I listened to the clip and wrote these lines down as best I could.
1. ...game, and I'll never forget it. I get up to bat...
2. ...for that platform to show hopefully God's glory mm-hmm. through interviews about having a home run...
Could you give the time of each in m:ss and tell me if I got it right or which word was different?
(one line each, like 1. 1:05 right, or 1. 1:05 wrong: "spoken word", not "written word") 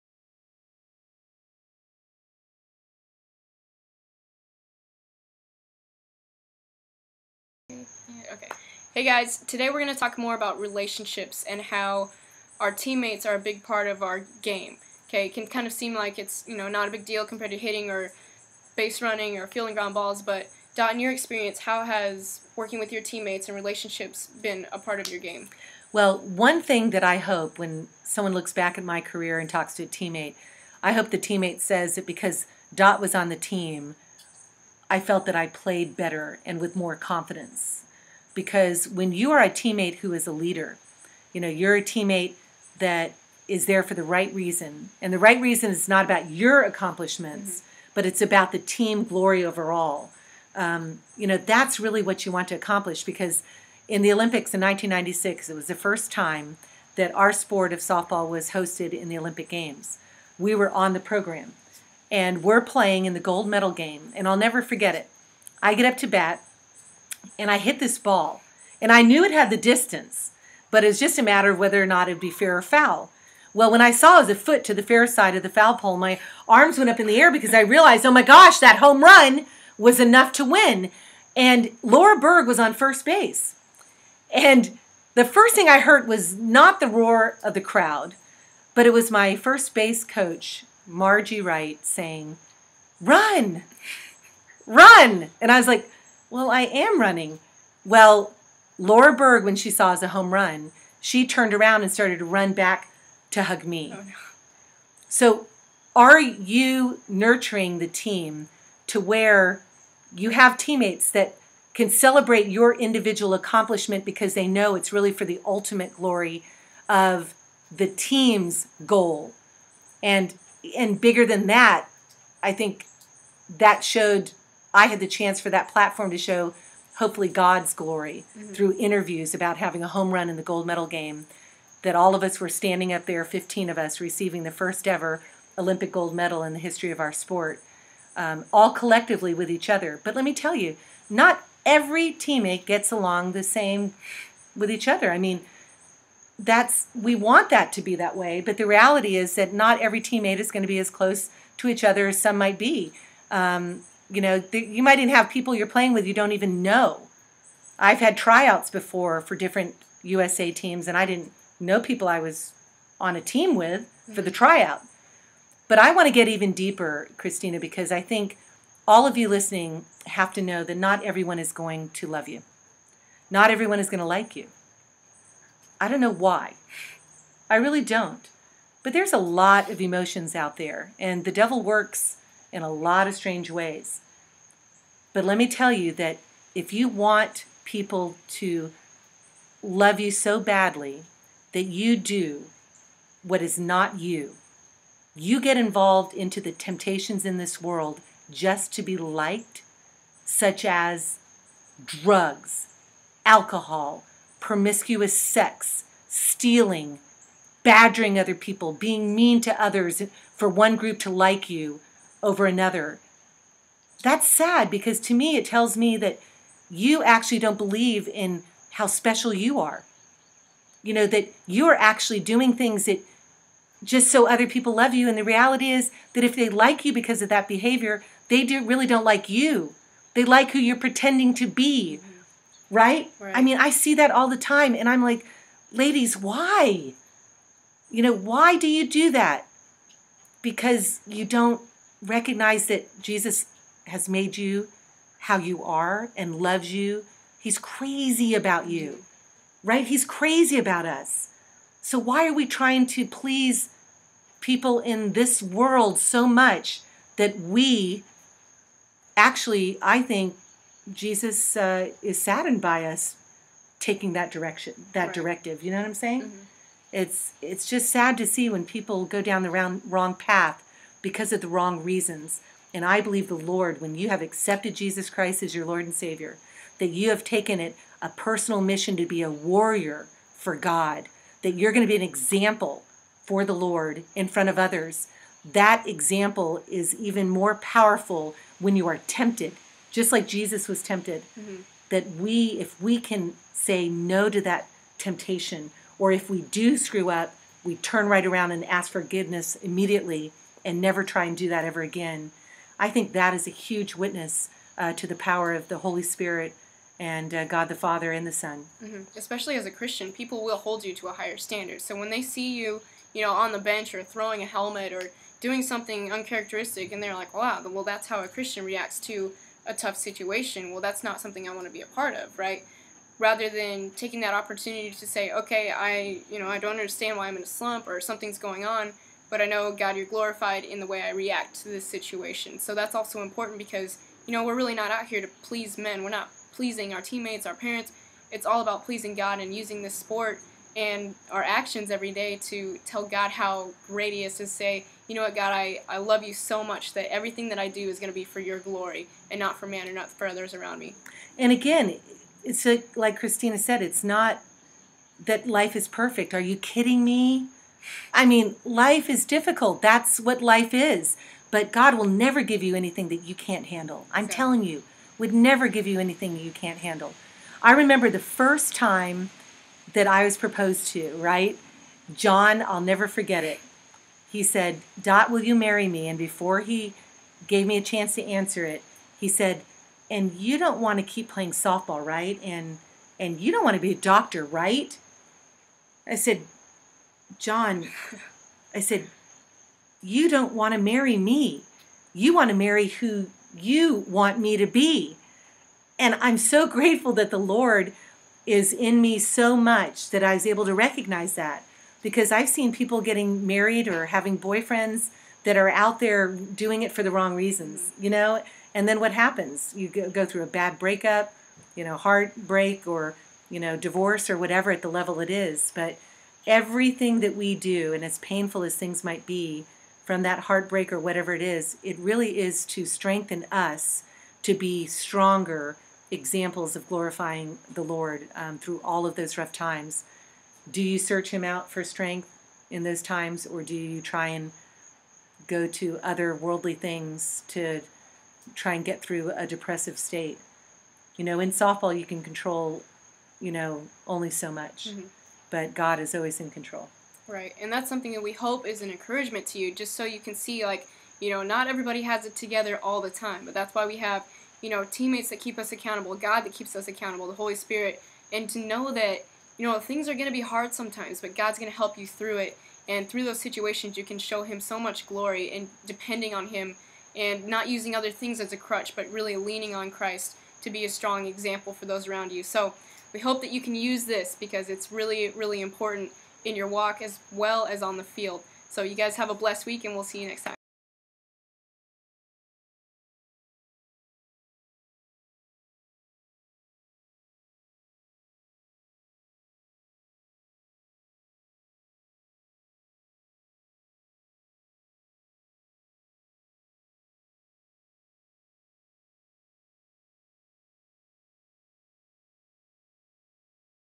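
1. 1:03 right
2. 2:05 right.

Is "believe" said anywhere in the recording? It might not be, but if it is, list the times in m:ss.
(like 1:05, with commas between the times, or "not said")
3:37, 4:33.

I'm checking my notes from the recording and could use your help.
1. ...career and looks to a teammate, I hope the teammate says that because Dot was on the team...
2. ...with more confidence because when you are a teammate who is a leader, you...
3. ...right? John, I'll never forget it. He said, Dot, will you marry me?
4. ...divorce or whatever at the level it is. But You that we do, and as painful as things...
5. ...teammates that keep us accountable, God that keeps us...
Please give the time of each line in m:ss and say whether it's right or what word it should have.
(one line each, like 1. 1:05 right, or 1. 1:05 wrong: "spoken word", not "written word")
1. 0:28 wrong: "talks", not "looks"
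2. 0:36 right
3. 6:11 right
4. 6:53 wrong: "Everything", not "You"
5. 7:34 right.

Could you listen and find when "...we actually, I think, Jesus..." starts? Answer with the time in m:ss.
4:17.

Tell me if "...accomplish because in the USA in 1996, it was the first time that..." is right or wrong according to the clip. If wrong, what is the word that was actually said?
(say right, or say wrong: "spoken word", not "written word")
wrong: "Olympics", not "USA".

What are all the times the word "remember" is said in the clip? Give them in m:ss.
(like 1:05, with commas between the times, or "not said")
6:07.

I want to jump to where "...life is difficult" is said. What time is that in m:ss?
5:58.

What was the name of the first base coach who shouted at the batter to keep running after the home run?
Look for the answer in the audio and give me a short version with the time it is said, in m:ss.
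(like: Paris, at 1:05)
Margie Wright, at 1:30.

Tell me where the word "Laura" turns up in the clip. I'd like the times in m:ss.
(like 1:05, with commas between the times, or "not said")
1:21, 1:38.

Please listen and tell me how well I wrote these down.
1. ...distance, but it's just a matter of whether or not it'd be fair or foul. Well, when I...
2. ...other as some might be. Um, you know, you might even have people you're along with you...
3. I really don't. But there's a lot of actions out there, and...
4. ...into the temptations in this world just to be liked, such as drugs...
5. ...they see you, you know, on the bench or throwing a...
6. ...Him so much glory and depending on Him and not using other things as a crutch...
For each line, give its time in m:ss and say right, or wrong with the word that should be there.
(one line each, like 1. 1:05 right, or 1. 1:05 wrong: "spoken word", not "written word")
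1. 1:09 right
2. 2:31 wrong: "playing", not "along"
3. 2:57 wrong: "emotions", not "actions"
4. 3:16 right
5. 5:12 right
6. 7:44 right.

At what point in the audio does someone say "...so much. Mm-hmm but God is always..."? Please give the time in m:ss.
7:24.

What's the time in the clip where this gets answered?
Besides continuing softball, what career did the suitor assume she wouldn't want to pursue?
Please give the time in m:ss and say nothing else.
6:23.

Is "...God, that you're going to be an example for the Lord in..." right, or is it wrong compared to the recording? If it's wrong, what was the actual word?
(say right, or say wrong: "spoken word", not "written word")
right.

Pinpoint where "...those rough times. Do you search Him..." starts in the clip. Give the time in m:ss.
7:09.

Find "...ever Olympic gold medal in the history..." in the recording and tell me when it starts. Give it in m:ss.
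2:14.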